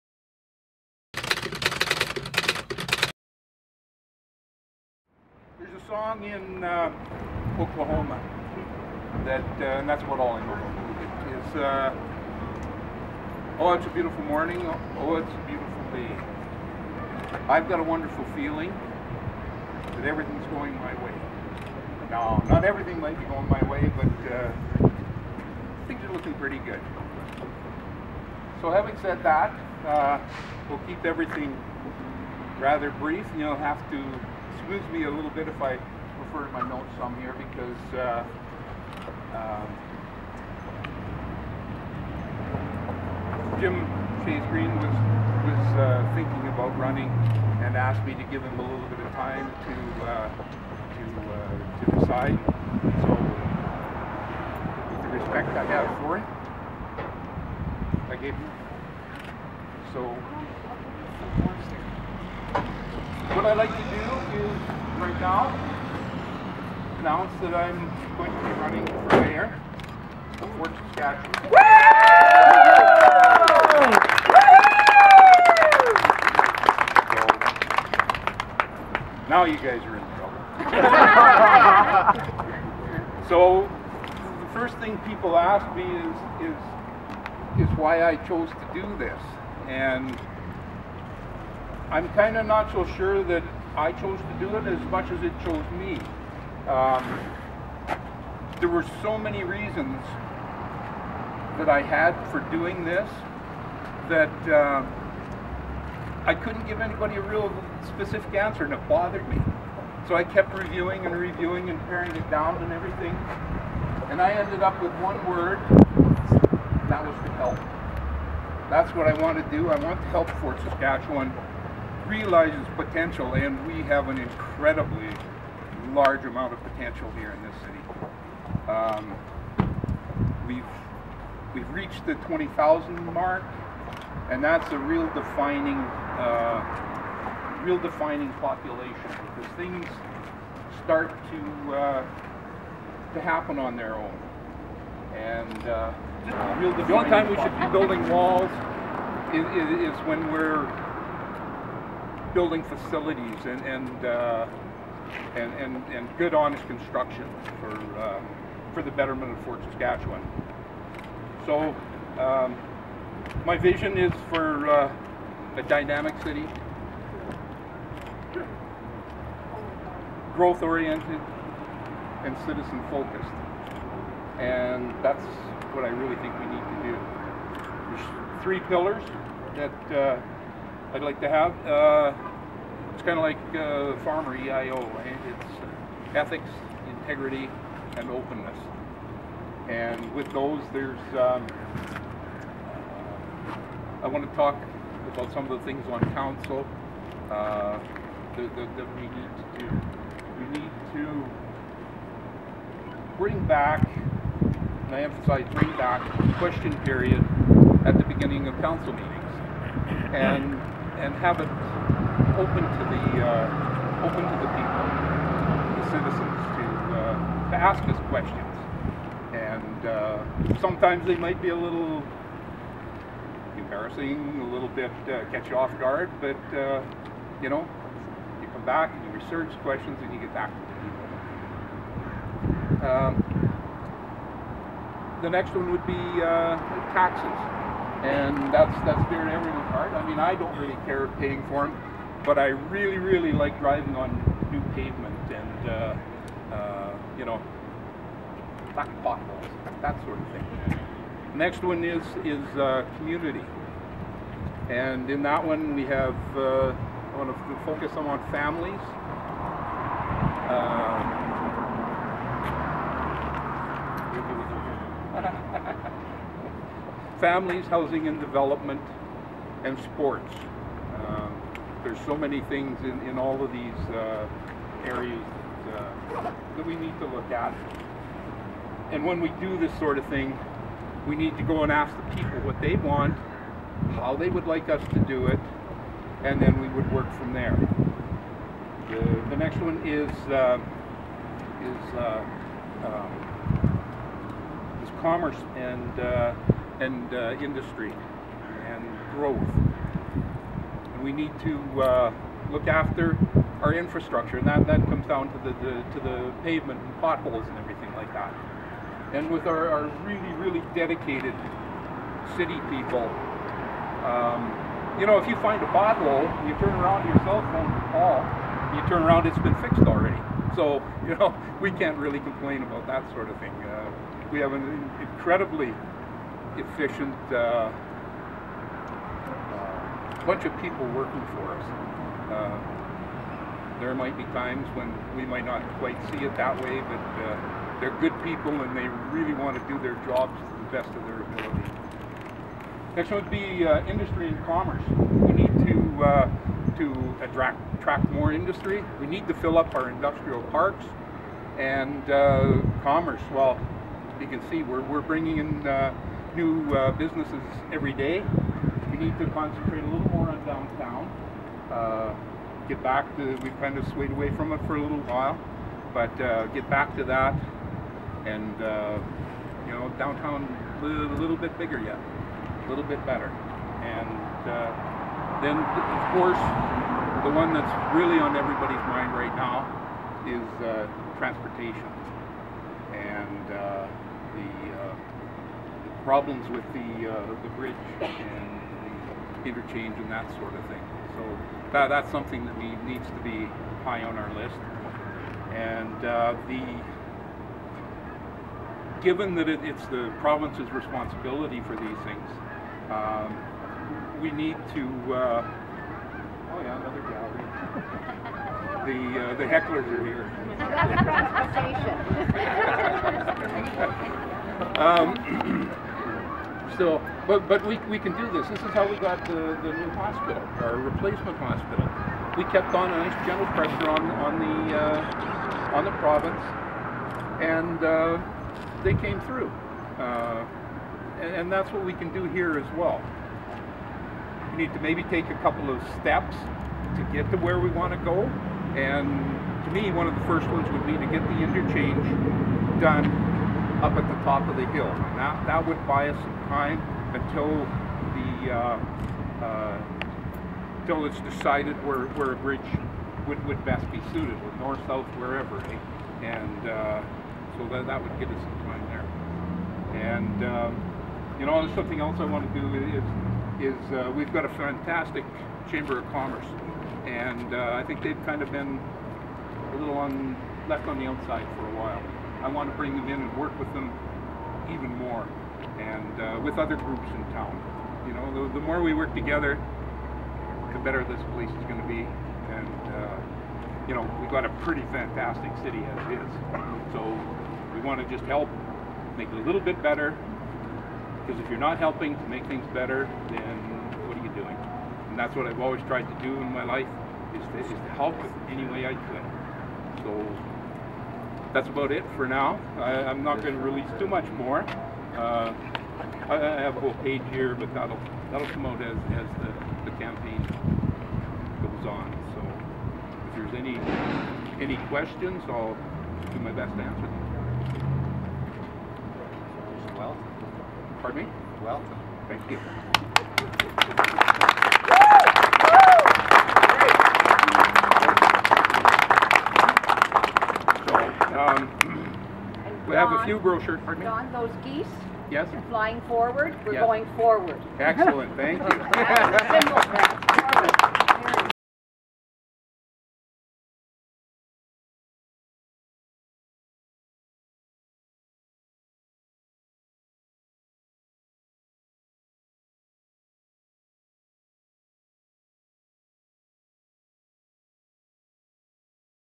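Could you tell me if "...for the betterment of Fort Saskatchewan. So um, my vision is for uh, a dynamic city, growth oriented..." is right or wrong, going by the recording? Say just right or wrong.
right.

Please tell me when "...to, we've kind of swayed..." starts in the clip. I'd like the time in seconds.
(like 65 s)
363 s.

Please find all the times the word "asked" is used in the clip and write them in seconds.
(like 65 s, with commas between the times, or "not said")
47 s.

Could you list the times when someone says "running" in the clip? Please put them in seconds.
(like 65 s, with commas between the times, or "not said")
46 s, 68 s.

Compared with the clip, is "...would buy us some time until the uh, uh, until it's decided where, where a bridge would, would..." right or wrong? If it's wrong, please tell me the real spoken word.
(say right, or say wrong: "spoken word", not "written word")
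right.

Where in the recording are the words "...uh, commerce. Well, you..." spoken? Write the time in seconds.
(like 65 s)
352 s.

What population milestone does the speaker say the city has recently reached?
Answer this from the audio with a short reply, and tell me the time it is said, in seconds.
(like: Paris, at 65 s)
20,000, at 132 s.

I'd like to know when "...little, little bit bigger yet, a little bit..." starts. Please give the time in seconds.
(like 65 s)
370 s.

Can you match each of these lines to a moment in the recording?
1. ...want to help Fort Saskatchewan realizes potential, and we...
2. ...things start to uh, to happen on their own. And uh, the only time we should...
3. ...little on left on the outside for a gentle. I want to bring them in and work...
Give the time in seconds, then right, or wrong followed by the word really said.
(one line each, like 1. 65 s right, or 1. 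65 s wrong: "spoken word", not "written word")
1. 119 s right
2. 139 s right
3. 469 s wrong: "while", not "gentle".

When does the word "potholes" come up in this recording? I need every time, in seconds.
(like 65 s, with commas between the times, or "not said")
249 s, 306 s, 315 s.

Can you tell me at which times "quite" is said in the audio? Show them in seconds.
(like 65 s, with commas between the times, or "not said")
335 s.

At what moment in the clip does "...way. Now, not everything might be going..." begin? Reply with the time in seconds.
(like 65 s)
21 s.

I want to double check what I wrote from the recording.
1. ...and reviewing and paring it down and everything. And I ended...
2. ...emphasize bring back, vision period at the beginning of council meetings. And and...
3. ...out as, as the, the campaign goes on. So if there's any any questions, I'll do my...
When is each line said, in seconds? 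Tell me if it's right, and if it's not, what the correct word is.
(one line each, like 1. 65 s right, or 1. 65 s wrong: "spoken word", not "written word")
1. 111 s right
2. 205 s wrong: "question", not "vision"
3. 508 s right.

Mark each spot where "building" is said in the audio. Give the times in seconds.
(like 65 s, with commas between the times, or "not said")
147 s, 152 s.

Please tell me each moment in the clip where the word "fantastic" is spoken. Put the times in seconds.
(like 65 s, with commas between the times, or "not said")
464 s, 484 s.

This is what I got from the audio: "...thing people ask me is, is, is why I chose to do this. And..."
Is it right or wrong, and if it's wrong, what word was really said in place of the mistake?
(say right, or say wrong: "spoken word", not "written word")
right.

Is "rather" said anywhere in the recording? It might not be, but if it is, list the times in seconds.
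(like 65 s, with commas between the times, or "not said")
32 s.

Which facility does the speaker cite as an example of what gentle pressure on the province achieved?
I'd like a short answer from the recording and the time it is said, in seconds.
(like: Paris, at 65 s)
Replacement hospital, at 420 s.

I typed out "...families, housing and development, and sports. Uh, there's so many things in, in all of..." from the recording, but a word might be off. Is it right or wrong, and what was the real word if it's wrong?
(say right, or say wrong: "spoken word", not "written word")
right.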